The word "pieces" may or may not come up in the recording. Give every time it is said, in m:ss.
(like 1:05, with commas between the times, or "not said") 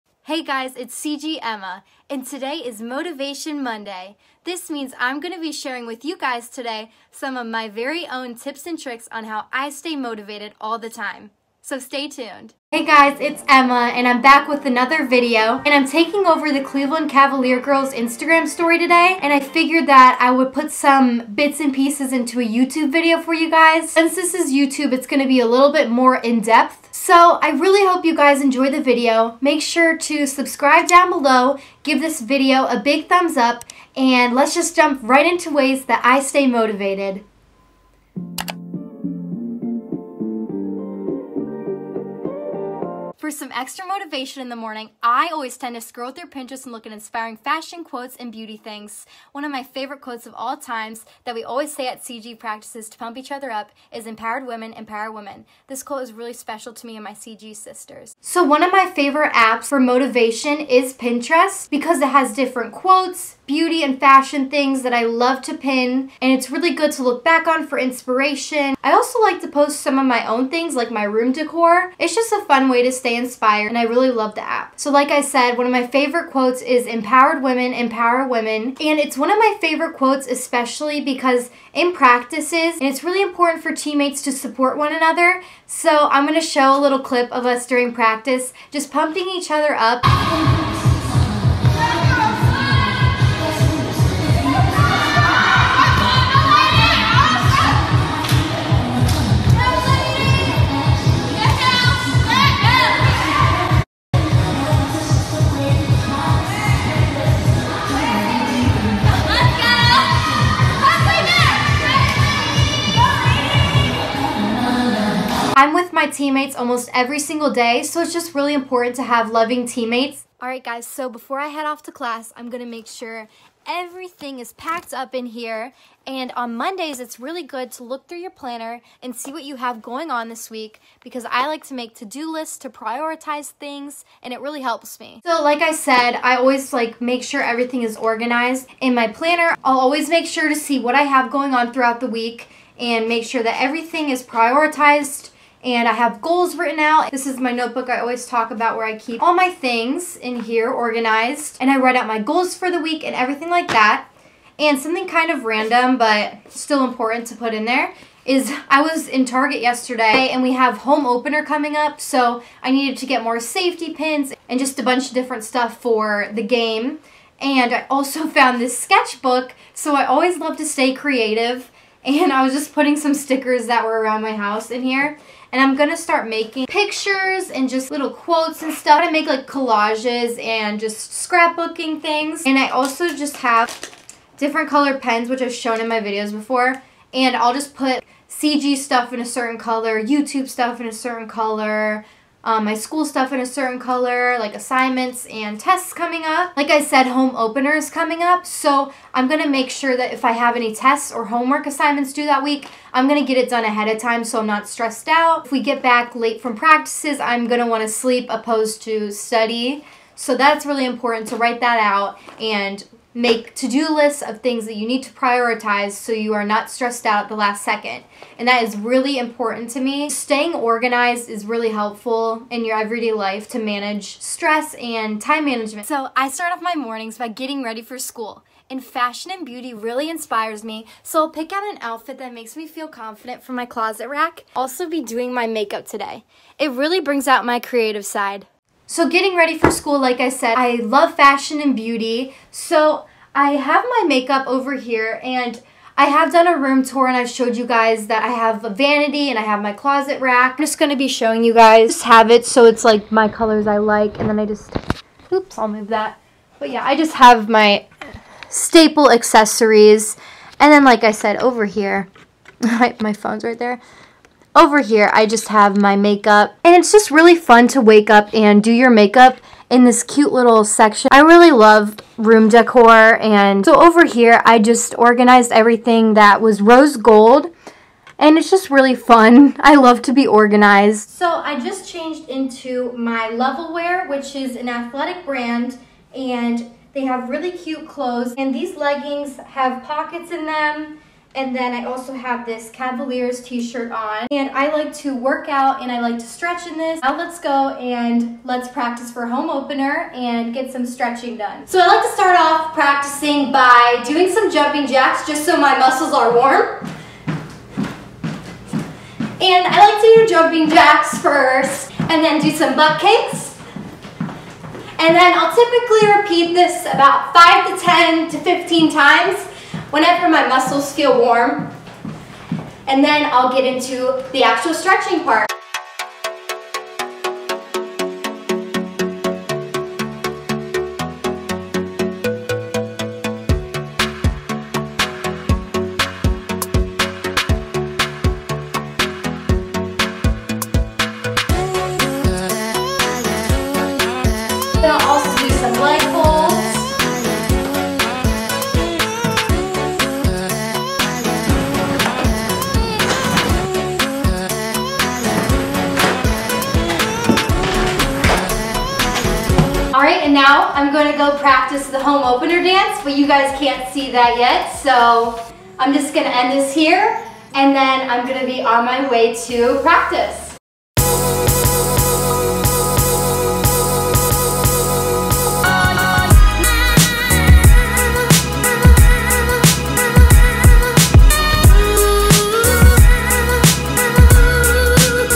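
0:21.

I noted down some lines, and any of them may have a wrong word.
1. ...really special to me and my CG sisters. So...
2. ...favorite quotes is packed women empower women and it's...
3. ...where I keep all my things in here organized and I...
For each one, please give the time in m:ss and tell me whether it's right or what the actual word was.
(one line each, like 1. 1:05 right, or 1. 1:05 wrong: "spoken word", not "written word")
1. 0:56 right
2. 1:15 wrong: "empowered", not "packed"
3. 2:28 right.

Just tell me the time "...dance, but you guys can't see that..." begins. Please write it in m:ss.
6:02.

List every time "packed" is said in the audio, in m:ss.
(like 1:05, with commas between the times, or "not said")
2:04.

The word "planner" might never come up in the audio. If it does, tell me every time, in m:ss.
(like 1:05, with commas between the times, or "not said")
2:08, 2:19.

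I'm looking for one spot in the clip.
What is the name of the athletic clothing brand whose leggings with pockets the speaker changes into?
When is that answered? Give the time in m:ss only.
4:43.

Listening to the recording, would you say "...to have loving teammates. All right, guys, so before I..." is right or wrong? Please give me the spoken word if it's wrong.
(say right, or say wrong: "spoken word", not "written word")
right.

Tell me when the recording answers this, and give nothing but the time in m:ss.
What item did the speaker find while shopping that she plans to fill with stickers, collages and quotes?
2:48.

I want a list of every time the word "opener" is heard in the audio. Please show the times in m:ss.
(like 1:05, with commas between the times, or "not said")
2:41, 3:17, 4:59, 6:02.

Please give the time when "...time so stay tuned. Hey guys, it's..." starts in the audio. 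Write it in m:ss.
0:10.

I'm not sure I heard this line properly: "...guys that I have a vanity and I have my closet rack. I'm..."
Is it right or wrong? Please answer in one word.
right.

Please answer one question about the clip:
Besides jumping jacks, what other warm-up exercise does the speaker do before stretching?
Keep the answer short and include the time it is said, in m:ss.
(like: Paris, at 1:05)
butt kicks, at 5:12.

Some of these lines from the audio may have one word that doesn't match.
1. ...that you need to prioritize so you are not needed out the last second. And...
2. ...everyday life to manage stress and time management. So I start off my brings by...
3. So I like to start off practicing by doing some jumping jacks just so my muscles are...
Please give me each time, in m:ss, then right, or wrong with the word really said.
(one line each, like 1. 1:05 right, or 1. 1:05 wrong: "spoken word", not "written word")
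1. 3:34 wrong: "stressed", not "needed"
2. 3:42 wrong: "mornings", not "brings"
3. 5:01 right.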